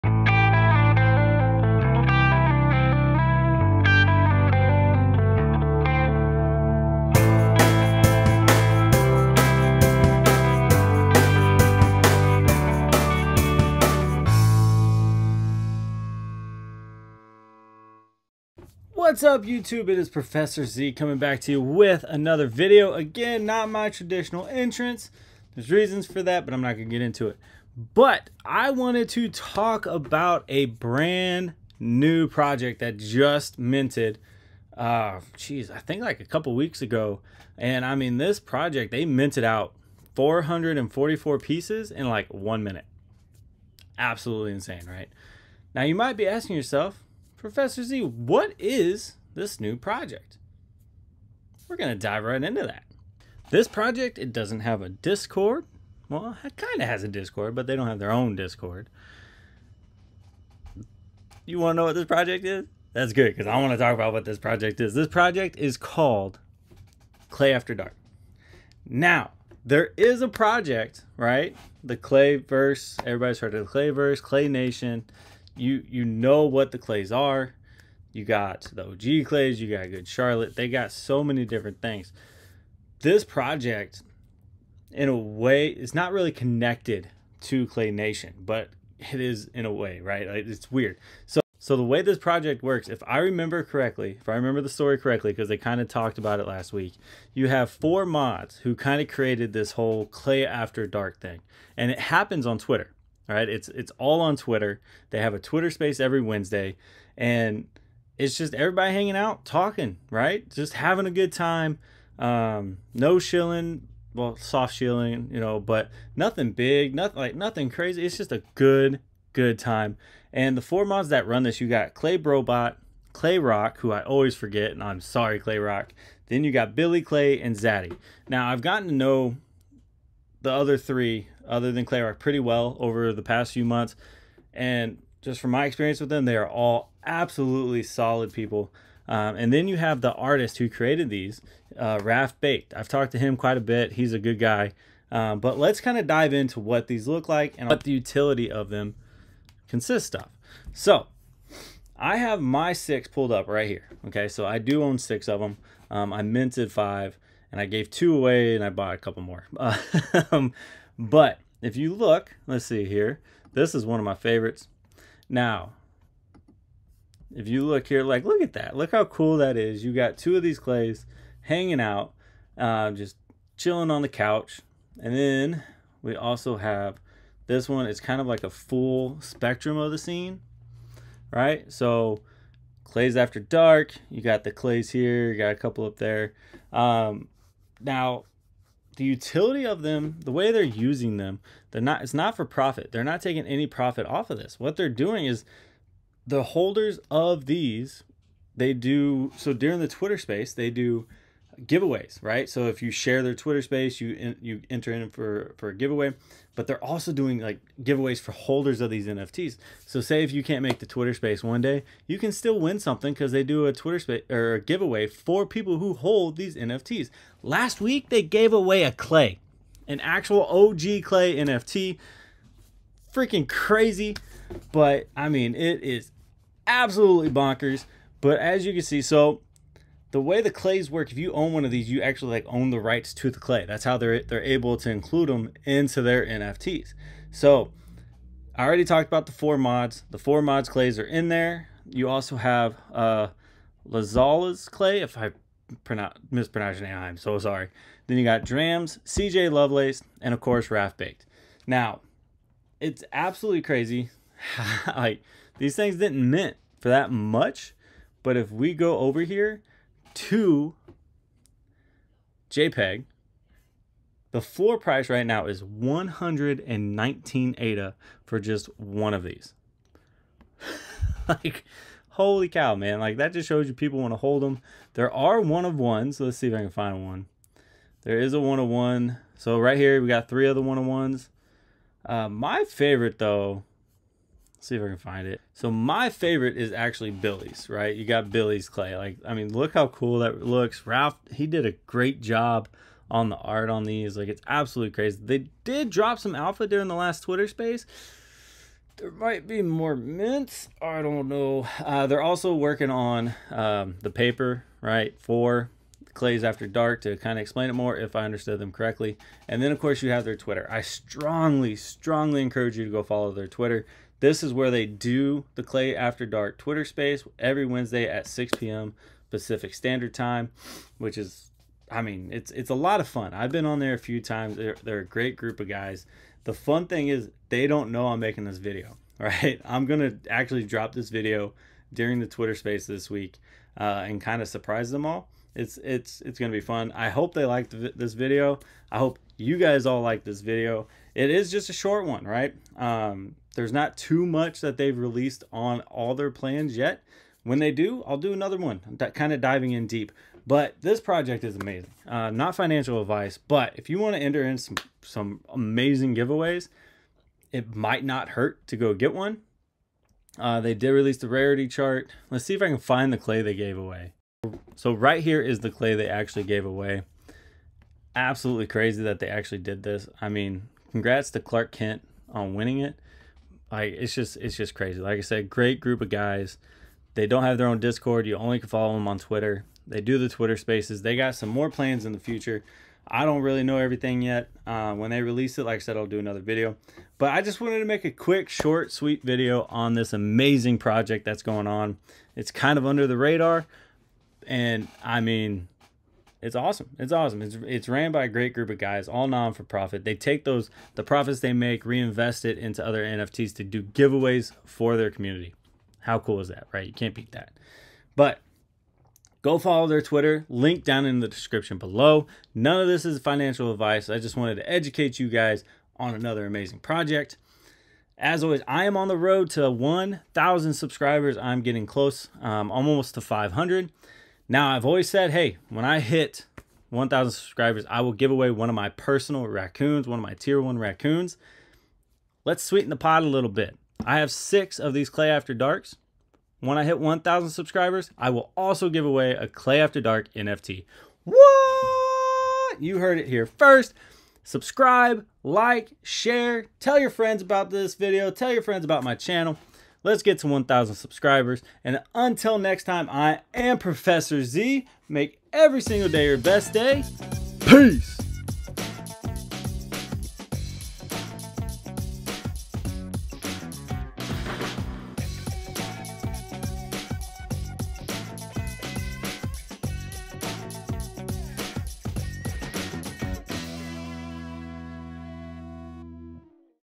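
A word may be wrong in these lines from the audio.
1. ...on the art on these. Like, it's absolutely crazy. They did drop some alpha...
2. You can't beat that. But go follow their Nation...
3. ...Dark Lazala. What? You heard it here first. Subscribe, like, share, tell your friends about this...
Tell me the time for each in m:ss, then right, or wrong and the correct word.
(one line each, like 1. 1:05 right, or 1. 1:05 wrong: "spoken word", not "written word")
1. 4:53 right
2. 6:46 wrong: "Twitter", not "Nation"
3. 7:20 wrong: "NFT", not "Lazala".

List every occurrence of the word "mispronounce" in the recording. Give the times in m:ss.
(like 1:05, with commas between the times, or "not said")
4:06.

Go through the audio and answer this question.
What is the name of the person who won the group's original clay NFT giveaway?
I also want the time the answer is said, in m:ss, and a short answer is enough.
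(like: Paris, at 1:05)
Clark Kent, at 6:11.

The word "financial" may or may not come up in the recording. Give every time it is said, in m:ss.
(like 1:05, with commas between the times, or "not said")
5:52, 6:53.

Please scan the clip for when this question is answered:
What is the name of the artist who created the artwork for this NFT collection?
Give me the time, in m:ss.
2:22.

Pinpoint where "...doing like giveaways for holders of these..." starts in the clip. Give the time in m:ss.
3:27.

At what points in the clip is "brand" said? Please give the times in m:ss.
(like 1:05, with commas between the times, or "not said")
0:30.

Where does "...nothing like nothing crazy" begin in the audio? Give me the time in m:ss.
1:56.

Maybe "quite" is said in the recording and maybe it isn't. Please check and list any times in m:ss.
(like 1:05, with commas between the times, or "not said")
2:23.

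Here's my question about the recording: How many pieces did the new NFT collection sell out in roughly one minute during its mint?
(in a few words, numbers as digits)
444.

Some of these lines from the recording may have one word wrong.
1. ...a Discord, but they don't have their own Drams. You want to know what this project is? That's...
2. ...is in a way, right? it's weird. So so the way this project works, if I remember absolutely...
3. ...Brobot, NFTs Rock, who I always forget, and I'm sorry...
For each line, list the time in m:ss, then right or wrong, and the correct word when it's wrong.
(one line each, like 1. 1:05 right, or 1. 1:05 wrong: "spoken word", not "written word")
1. 0:57 wrong: "Discord", not "Drams"
2. 1:29 wrong: "correctly", not "absolutely"
3. 2:02 wrong: "Clay", not "NFTs".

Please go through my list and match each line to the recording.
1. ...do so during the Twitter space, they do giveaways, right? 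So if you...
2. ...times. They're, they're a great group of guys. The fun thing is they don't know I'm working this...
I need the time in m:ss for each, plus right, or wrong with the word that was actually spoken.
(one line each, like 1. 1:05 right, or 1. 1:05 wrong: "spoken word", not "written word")
1. 3:18 right
2. 5:24 wrong: "making", not "working".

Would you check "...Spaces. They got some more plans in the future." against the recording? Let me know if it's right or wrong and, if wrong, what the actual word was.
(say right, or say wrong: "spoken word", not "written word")
right.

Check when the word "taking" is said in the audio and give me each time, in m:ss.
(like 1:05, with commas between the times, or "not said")
3:13.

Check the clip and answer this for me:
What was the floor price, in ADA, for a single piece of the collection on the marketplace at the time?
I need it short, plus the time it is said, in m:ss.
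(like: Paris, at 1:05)
119 ADA, at 4:25.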